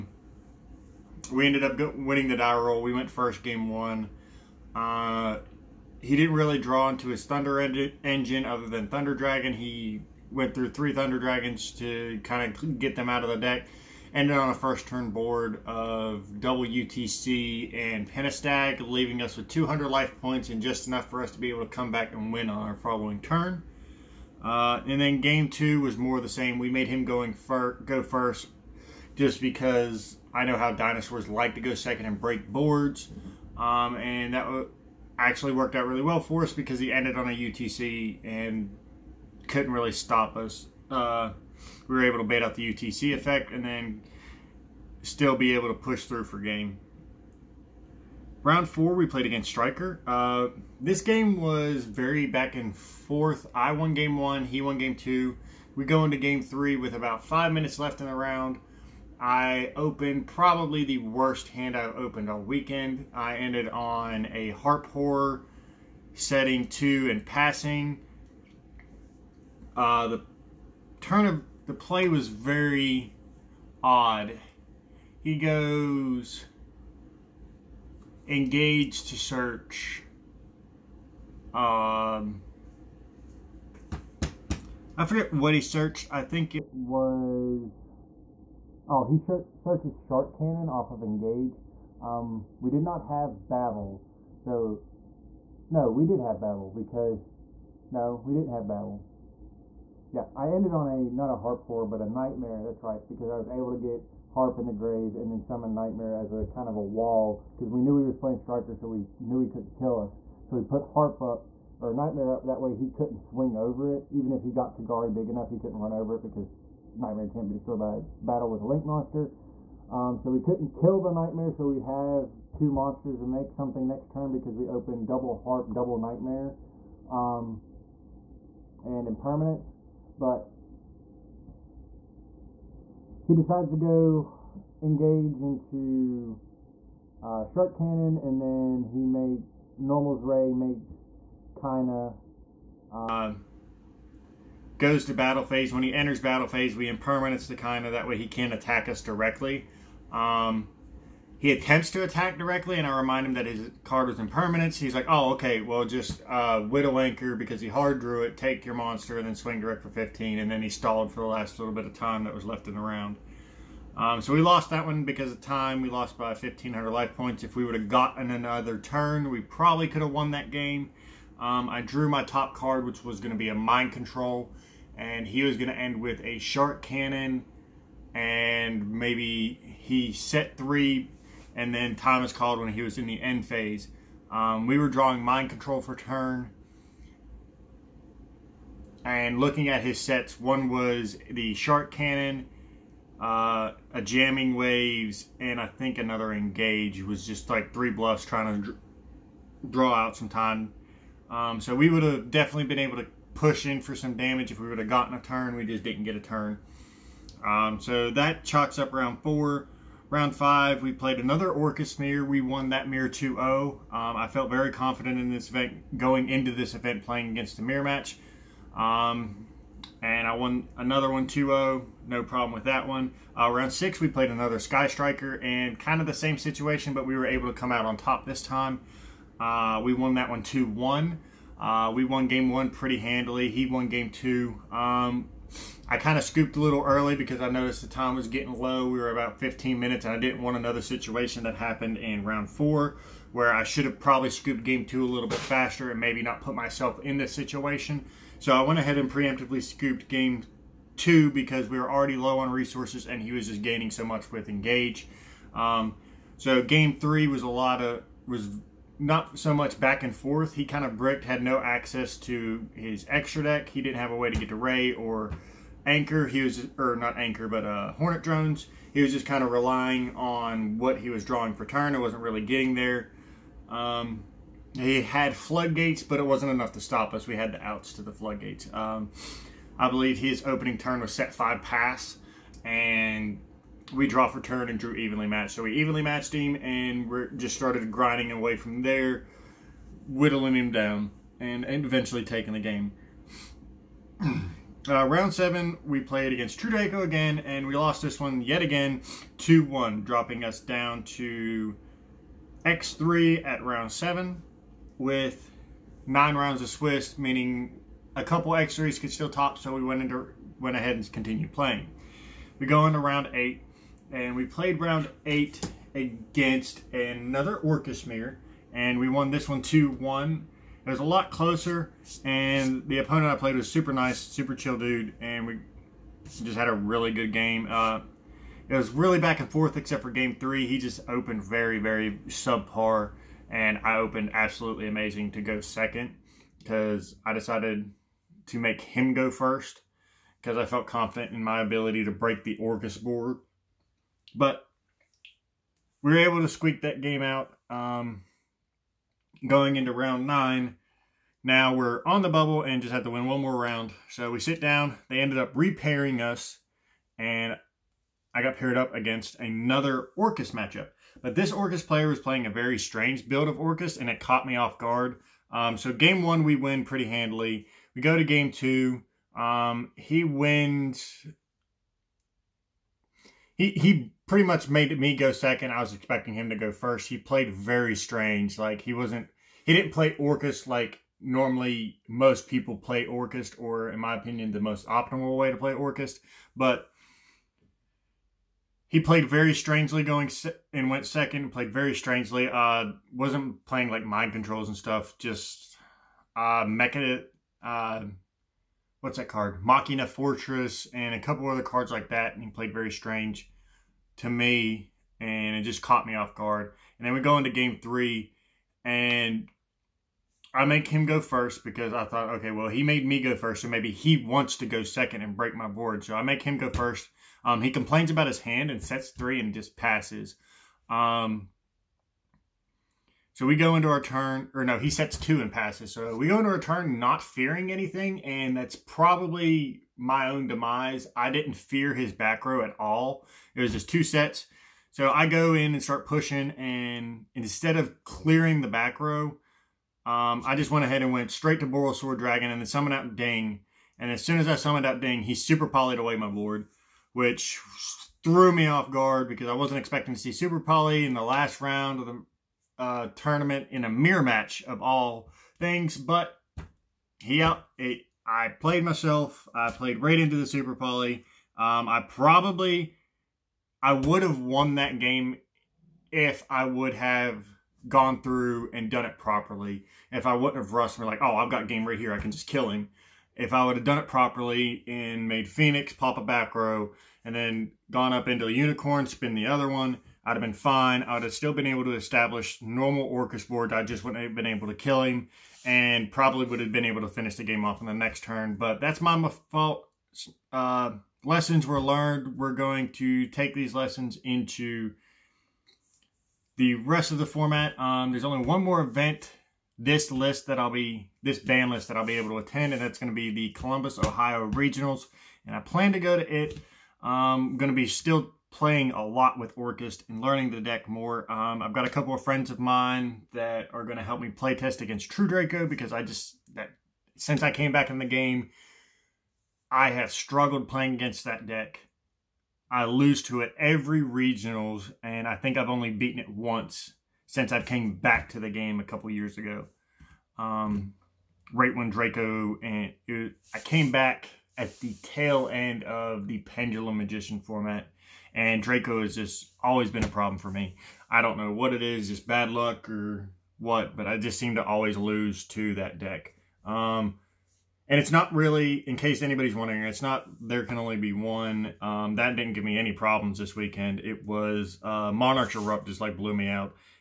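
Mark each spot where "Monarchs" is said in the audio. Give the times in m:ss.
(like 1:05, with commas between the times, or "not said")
9:15.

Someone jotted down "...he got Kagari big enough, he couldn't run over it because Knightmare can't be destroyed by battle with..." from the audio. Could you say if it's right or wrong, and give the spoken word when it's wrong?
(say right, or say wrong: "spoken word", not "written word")
right.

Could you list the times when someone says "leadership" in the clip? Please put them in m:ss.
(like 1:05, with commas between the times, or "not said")
not said.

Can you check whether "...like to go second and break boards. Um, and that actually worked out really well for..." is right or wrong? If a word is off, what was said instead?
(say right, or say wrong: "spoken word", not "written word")
right.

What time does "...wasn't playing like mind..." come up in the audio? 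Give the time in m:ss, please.
6:33.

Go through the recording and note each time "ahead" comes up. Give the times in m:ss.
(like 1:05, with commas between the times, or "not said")
4:08, 5:10, 7:20.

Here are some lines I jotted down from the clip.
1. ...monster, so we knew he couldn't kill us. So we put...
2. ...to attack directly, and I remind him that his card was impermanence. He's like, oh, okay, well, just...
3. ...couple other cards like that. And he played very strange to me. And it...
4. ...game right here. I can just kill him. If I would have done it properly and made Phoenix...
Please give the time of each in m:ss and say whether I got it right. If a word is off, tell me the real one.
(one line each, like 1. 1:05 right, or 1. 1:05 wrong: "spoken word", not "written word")
1. 1:48 wrong: "striker", not "monster"
2. 2:31 right
3. 6:41 right
4. 7:51 right.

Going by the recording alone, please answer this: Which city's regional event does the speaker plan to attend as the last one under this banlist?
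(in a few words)
Columbus, Ohio.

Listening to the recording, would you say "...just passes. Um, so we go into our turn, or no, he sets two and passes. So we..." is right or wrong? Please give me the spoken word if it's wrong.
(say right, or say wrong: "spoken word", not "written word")
right.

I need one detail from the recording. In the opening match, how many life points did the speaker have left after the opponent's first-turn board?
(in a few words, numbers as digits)
200.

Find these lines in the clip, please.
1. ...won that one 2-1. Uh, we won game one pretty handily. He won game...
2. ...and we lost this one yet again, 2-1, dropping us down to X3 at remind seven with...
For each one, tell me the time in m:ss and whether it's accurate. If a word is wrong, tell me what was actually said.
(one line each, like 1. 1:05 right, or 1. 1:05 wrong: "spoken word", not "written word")
1. 3:49 right
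2. 4:57 wrong: "round", not "remind".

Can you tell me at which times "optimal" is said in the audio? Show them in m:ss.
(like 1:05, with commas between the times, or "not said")
6:24.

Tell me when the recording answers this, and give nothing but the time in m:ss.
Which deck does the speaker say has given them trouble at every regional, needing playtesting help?
8:35.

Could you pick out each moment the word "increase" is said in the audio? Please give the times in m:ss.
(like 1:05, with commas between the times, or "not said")
not said.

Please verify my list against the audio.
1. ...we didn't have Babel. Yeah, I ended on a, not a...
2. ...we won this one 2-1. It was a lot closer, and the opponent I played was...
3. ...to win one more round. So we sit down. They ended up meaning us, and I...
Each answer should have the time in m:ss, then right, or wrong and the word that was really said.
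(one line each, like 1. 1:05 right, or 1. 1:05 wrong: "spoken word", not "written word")
1. 1:38 right
2. 5:18 right
3. 5:53 wrong: "repairing", not "meaning".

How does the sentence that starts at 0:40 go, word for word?
Uh, we were able to bait out the UTC effect and then still be able to push through for game.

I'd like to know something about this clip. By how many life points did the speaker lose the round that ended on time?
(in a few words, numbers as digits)
1,500.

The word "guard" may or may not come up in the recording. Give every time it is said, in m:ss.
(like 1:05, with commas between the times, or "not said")
6:04, 6:46, 7:28.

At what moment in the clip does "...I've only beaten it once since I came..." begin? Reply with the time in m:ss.
8:45.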